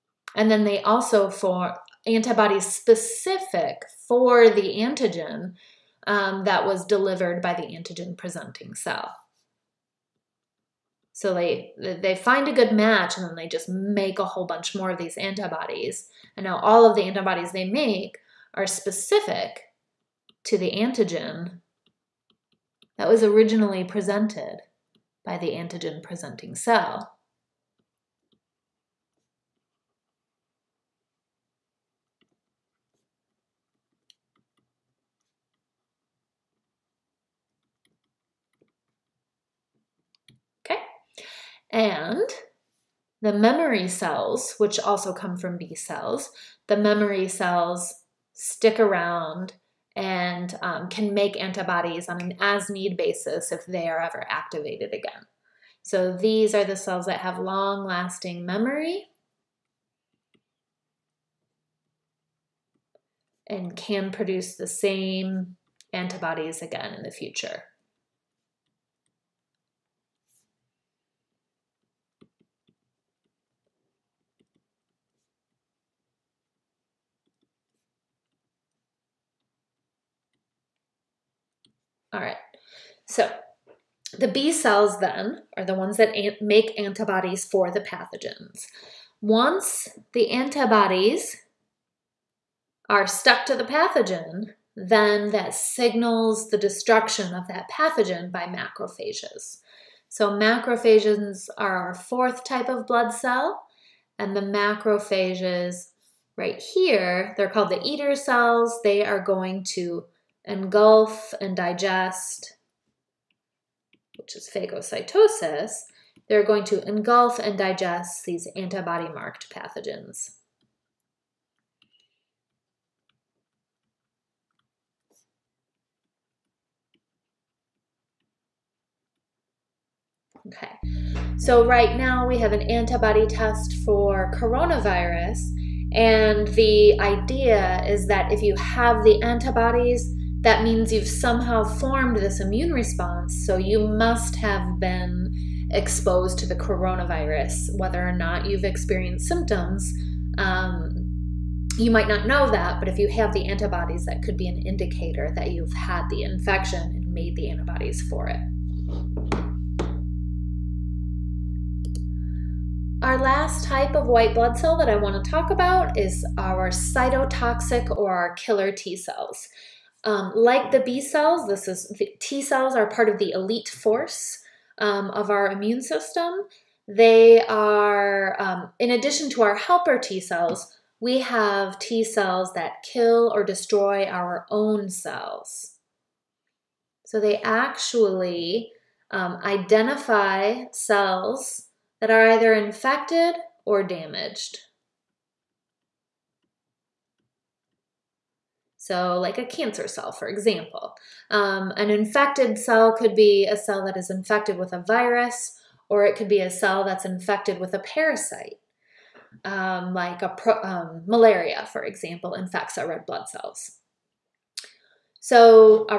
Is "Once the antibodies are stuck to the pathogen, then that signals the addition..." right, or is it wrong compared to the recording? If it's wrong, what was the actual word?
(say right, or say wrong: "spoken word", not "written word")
wrong: "destruction", not "addition".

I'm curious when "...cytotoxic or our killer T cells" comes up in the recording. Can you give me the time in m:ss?
2:46.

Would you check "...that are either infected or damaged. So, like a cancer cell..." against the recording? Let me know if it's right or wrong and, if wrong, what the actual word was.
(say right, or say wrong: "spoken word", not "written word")
right.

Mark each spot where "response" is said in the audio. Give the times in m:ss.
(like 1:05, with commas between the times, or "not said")
2:22.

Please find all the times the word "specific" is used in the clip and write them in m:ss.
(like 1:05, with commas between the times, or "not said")
0:02, 0:18.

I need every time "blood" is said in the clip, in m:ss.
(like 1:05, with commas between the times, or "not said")
1:42, 2:44, 3:33.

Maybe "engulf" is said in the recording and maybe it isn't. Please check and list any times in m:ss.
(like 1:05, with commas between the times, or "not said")
1:50, 1:56.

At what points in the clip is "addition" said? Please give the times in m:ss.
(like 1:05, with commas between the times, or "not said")
2:58.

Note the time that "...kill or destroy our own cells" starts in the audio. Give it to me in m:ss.
3:02.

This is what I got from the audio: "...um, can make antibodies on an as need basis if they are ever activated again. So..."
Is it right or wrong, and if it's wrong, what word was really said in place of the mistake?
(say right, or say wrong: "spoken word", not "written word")
right.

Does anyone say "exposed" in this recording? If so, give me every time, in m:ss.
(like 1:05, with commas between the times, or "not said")
2:25.